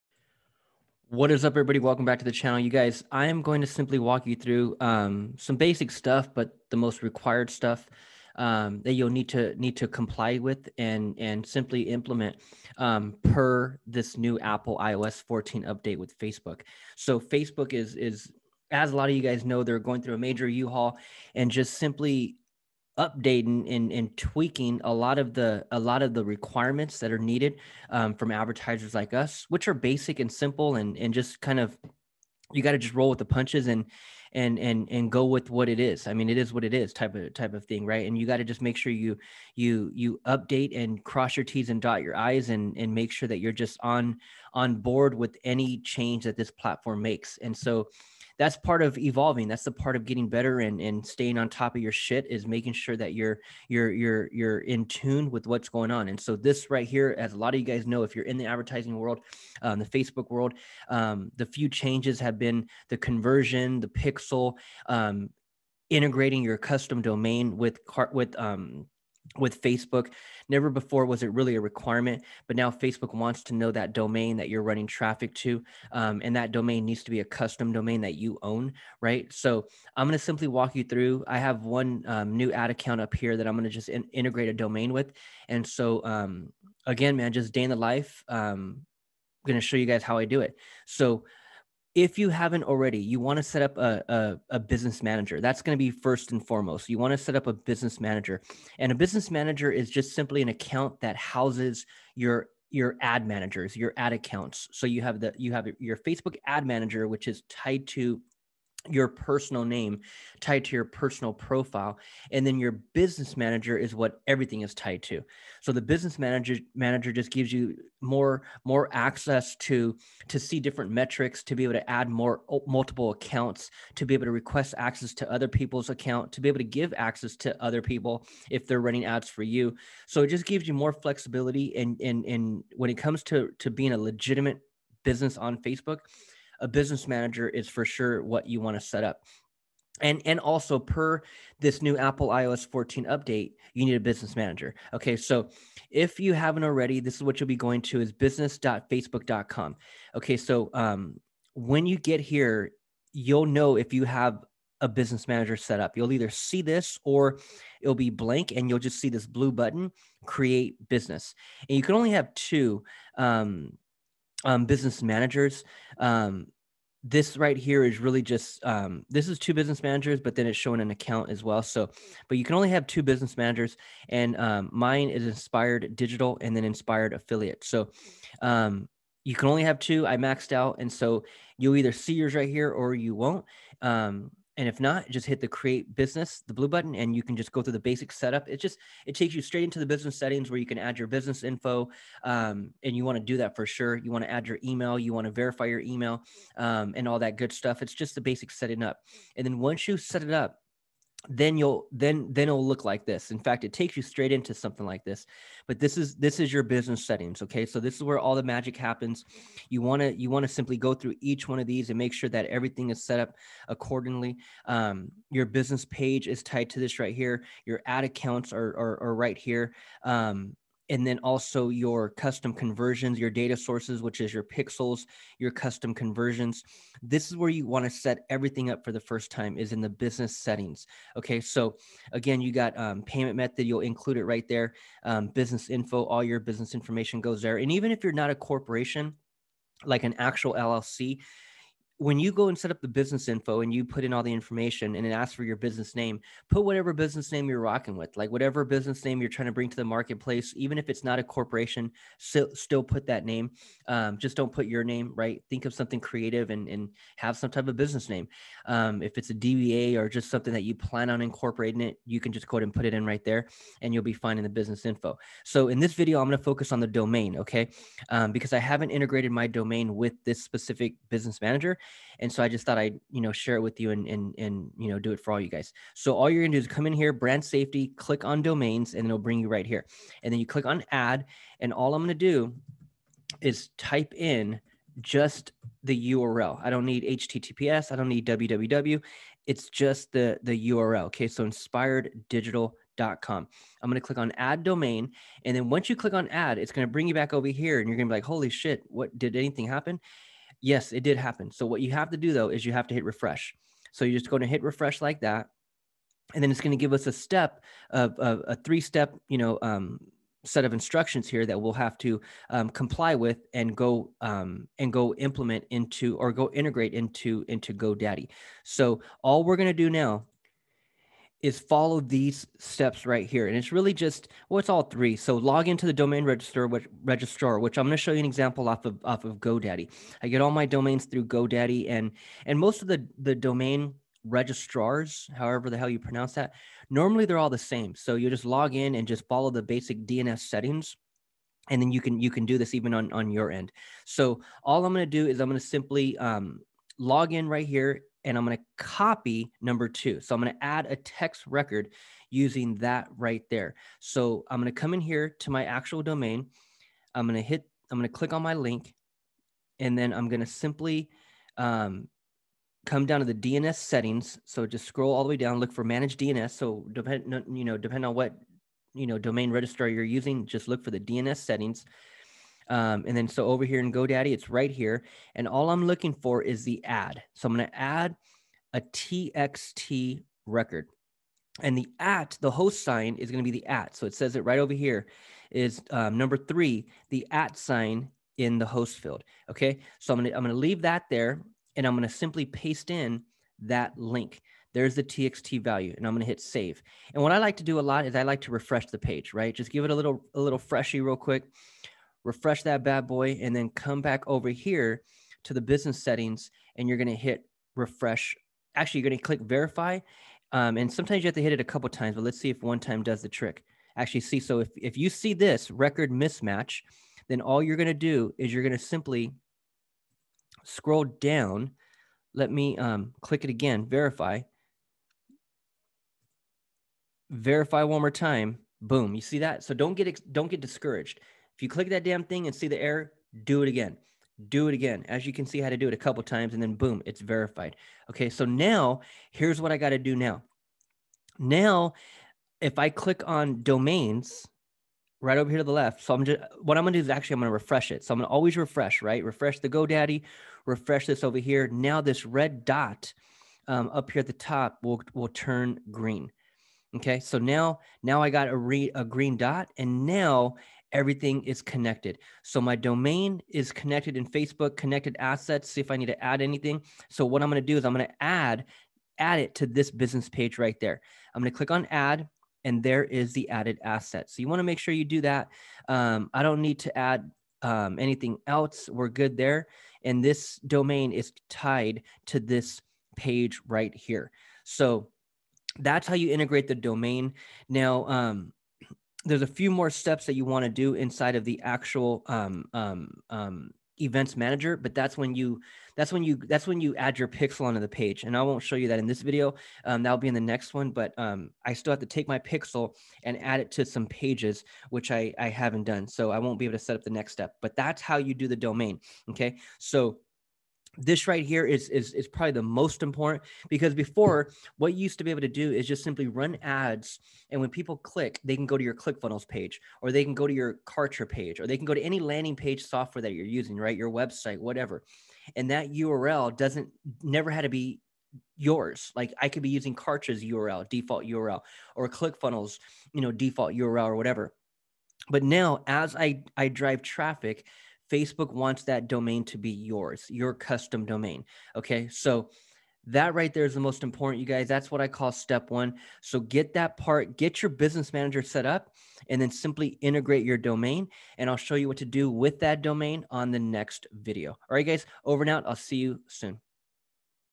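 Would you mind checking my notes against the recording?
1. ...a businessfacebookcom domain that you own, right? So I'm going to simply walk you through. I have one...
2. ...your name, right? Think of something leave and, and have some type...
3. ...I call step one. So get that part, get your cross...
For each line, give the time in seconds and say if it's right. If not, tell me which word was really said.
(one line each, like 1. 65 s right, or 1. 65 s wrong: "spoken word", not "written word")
1. 77 s wrong: "custom", not "businessfacebookcom"
2. 254 s wrong: "creative", not "leave"
3. 545 s wrong: "business", not "cross".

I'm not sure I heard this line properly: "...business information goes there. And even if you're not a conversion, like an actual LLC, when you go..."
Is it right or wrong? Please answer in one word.
wrong.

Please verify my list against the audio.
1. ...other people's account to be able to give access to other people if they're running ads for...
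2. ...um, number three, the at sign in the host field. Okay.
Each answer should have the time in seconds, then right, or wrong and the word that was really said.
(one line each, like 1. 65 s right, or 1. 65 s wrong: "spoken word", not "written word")
1. 125 s right
2. 385 s right.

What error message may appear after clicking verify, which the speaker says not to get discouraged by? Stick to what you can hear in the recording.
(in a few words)
Record mismatch.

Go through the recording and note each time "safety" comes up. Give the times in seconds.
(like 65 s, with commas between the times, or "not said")
277 s.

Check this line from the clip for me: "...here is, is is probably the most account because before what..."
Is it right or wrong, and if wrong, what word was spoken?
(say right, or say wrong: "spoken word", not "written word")
wrong: "important", not "account".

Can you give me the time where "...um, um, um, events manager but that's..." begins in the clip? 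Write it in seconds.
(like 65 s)
492 s.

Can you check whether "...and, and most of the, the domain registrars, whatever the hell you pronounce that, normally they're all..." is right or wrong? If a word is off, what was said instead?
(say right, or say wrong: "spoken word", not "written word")
wrong: "however", not "whatever".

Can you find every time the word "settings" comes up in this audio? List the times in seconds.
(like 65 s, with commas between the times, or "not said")
190 s, 198 s, 207 s, 230 s, 340 s, 363 s, 371 s, 406 s.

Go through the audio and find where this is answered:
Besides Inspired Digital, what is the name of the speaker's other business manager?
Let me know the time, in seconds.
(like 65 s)
176 s.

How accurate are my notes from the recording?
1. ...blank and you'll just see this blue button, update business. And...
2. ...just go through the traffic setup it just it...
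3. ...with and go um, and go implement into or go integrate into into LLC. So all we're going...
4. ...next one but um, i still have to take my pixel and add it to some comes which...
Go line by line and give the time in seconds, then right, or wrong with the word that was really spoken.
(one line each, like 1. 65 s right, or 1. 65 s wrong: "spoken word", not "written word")
1. 158 s wrong: "create", not "update"
2. 187 s wrong: "basic", not "traffic"
3. 313 s wrong: "GoDaddy", not "LLC"
4. 500 s wrong: "pages", not "comes".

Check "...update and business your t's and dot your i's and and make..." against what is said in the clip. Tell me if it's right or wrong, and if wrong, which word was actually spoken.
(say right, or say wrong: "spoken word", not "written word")
wrong: "cross", not "business".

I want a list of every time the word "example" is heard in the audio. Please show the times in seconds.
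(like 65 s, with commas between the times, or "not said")
328 s.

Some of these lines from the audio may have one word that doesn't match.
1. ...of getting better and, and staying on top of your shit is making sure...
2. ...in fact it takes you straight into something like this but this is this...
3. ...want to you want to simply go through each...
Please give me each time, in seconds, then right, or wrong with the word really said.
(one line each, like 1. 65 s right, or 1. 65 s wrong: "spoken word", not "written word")
1. 49 s right
2. 203 s right
3. 209 s right.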